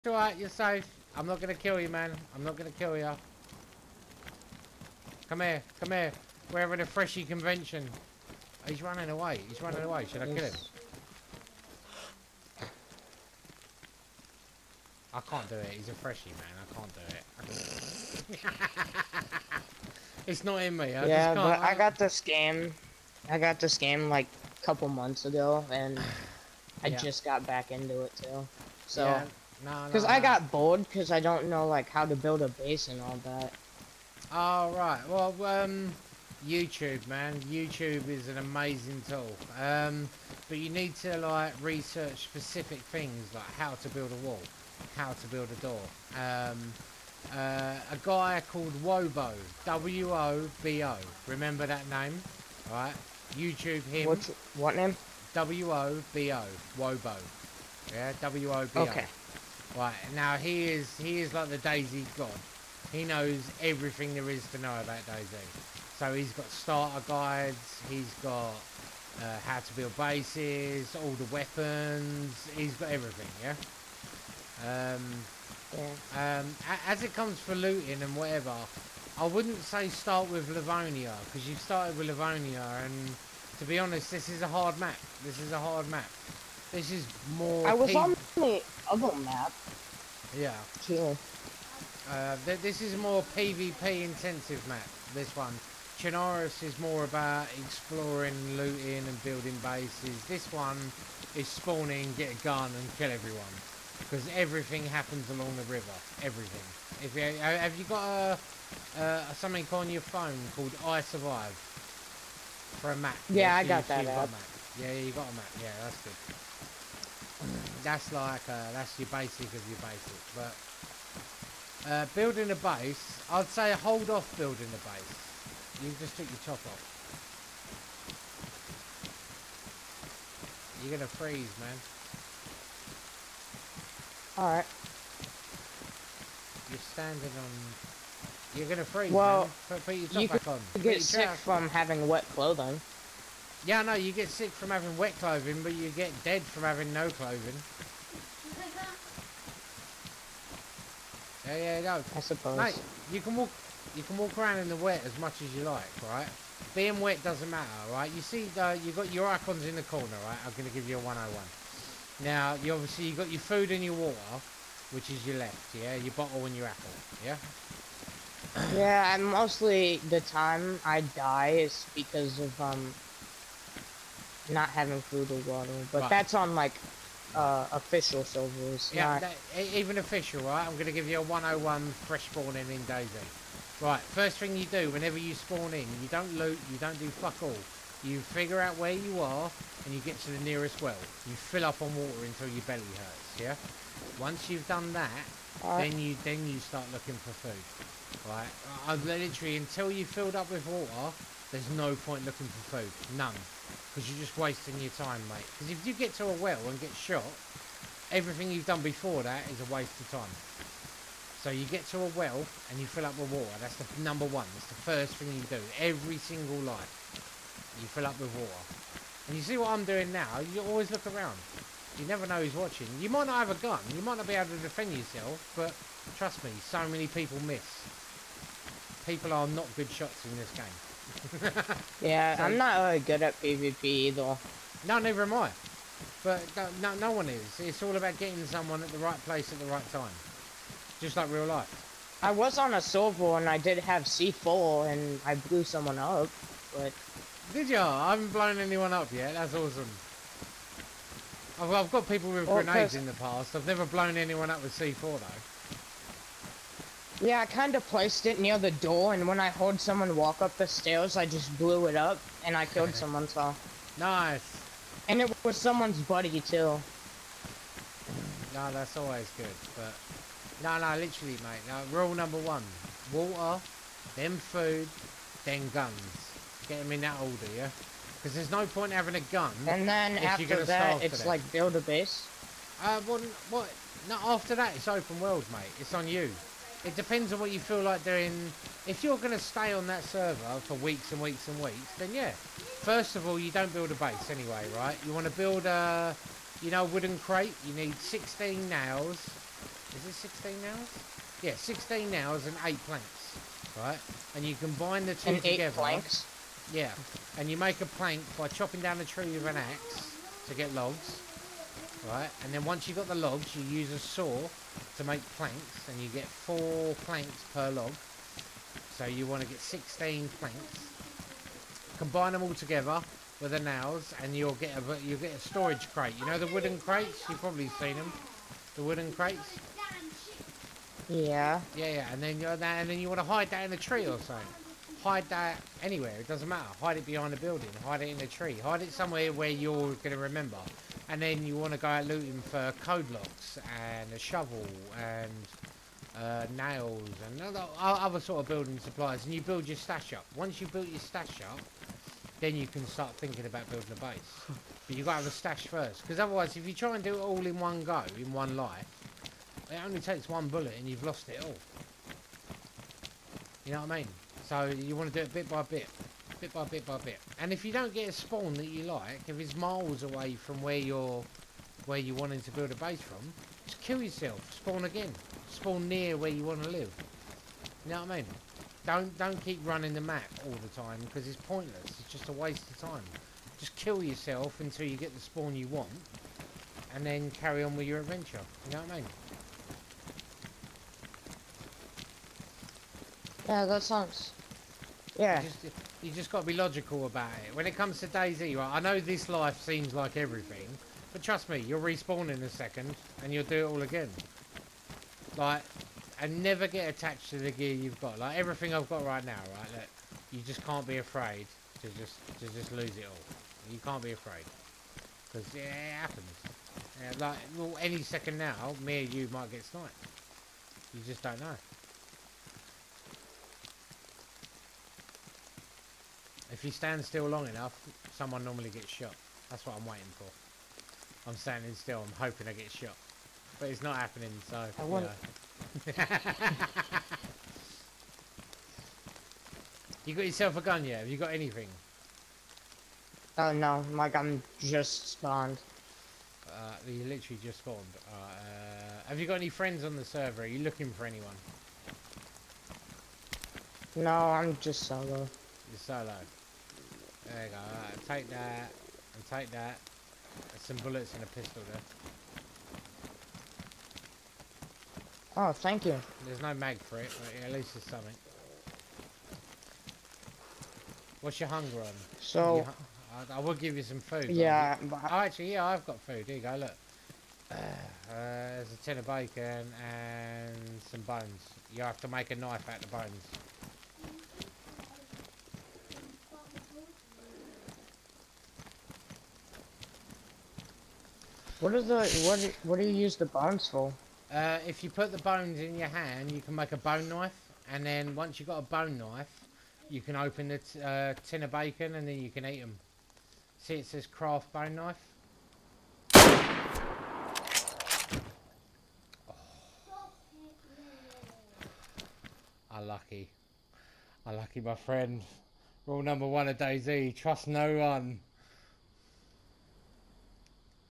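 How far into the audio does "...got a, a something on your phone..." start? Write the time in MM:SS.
01:47.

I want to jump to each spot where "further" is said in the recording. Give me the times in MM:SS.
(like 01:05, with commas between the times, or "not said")
not said.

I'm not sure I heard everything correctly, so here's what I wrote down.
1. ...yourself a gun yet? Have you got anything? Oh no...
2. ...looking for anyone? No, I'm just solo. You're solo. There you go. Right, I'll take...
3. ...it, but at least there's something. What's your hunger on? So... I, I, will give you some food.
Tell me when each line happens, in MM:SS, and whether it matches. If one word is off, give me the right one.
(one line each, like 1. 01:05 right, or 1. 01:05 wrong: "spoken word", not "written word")
1. 07:20 right
2. 07:30 right
3. 07:46 right.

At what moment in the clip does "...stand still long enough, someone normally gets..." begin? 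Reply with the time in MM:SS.
07:06.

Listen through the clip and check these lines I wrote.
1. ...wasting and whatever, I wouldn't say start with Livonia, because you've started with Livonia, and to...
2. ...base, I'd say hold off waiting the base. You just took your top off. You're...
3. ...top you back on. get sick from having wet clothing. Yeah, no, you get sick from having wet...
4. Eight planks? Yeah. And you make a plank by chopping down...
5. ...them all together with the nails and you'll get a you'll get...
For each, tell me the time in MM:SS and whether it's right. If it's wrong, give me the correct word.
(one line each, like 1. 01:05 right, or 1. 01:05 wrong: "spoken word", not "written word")
1. 01:17 wrong: "looting", not "wasting"
2. 02:02 wrong: "building", not "waiting"
3. 02:20 right
4. 05:05 right
5. 05:22 right.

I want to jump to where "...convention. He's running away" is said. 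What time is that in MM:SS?
00:07.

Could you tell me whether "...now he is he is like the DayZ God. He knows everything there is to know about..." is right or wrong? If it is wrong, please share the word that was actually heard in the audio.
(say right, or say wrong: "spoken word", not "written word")
right.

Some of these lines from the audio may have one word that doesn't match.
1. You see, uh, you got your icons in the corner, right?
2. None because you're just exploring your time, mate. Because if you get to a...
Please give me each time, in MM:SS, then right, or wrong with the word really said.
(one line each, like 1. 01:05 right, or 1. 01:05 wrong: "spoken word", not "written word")
1. 02:38 right
2. 03:23 wrong: "wasting", not "exploring".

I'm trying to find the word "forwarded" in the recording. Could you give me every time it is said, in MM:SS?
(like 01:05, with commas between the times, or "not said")
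not said.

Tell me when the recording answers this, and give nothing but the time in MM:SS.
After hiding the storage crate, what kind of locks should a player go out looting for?
05:42.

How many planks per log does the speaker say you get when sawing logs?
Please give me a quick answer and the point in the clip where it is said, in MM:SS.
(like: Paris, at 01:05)
4, at 05:16.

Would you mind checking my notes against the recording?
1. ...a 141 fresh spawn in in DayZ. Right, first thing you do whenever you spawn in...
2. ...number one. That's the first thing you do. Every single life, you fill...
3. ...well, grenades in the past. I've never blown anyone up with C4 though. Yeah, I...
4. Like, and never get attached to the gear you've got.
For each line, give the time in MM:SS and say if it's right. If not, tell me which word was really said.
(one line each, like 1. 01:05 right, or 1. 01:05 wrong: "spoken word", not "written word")
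1. 03:01 wrong: "101", not "141"
2. 03:34 right
3. 04:12 right
4. 06:45 right.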